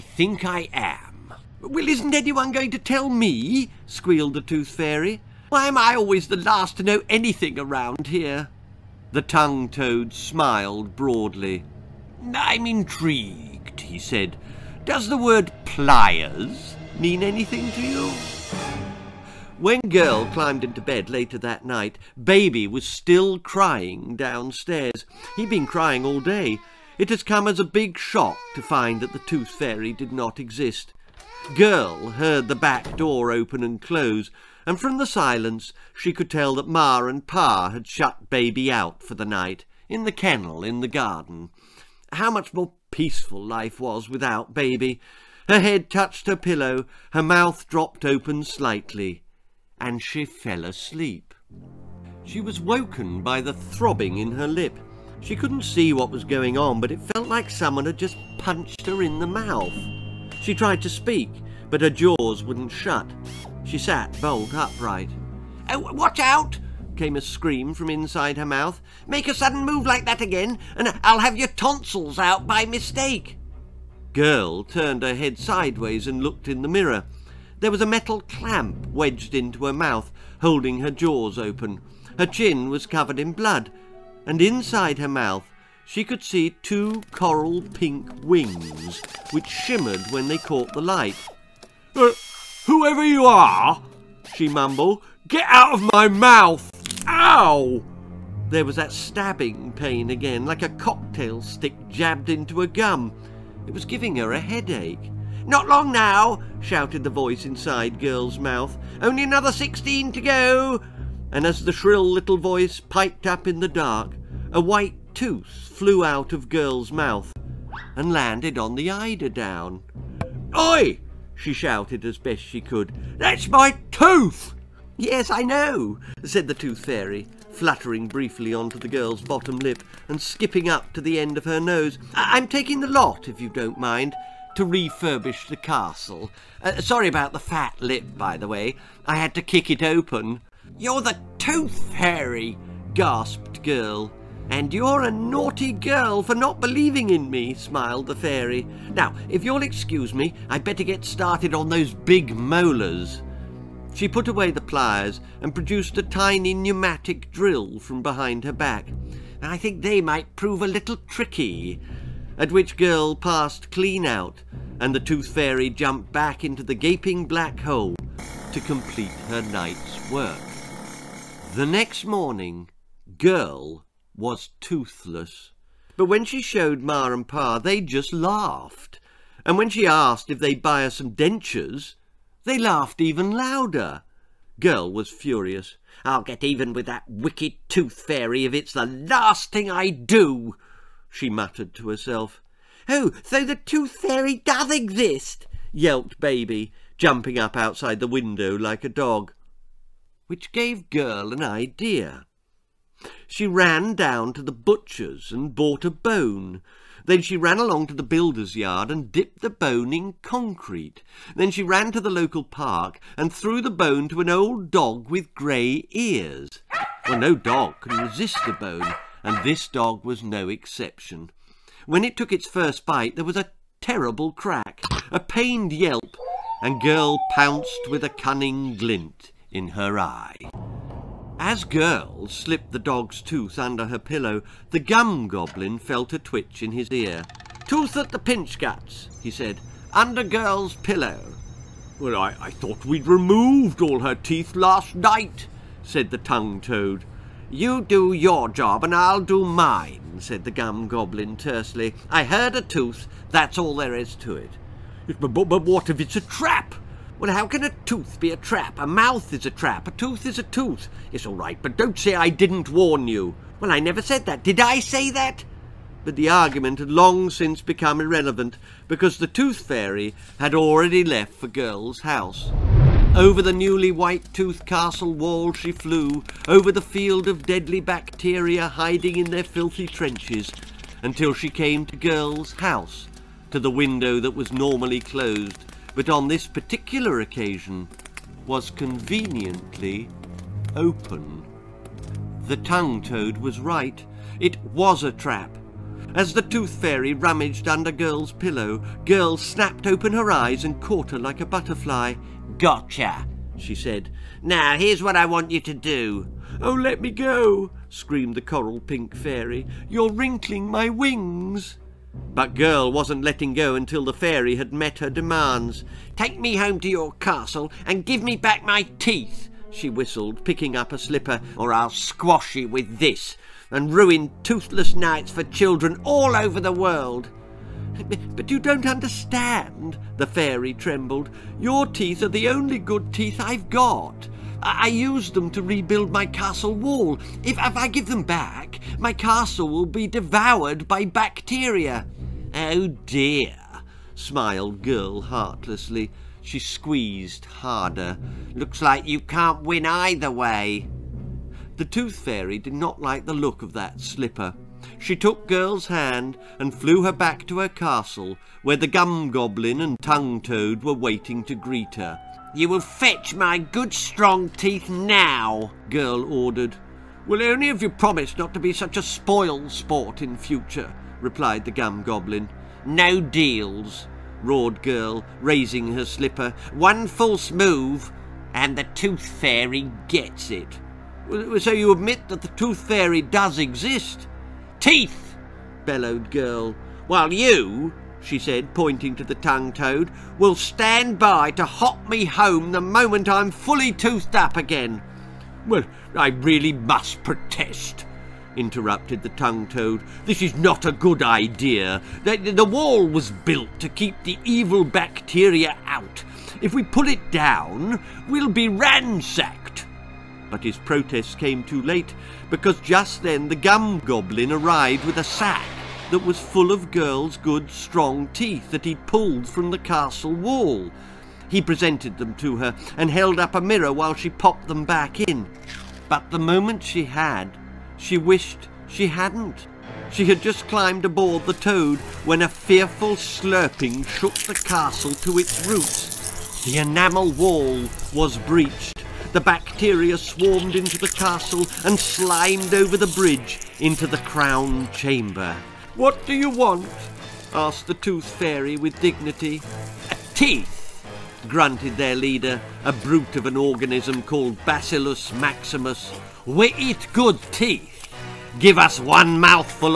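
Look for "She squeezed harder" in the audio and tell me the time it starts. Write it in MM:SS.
05:46.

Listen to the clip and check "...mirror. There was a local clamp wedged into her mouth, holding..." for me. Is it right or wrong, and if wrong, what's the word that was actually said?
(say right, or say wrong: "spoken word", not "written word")
wrong: "metal", not "local".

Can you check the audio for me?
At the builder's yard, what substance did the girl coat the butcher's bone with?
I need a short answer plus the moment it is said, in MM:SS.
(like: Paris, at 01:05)
Concrete, at 03:30.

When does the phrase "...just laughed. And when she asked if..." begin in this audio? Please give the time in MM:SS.
02:57.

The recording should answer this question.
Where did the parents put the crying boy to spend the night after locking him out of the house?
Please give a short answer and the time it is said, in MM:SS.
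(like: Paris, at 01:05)
The kennel in the garden, at 00:39.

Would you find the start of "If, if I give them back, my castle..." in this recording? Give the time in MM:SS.
05:37.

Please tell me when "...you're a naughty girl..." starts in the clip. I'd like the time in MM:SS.
02:24.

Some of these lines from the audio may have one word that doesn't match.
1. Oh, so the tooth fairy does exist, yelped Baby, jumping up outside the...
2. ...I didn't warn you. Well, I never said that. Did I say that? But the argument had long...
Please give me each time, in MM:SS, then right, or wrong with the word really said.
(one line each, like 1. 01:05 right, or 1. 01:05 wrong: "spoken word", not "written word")
1. 03:12 right
2. 04:22 right.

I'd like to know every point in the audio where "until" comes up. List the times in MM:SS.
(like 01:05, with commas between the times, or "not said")
04:41, 05:13.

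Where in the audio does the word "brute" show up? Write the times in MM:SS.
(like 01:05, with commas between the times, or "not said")
07:32.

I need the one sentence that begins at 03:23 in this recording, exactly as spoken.
She ran down to the butcher's and bought a bone.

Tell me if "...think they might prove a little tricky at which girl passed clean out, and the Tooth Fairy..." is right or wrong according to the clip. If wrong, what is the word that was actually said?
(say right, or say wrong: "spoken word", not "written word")
right.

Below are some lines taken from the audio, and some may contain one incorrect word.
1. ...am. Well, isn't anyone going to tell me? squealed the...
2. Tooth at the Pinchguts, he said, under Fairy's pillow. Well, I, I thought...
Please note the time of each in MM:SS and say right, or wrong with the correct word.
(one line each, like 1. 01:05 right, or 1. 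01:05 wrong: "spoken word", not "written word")
1. 00:00 right
2. 03:57 wrong: "Girl", not "Fairy".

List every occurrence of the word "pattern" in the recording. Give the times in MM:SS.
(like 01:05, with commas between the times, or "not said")
not said.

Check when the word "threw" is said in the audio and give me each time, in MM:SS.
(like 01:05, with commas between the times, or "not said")
03:33.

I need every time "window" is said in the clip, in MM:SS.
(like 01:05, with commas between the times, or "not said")
03:18, 04:43.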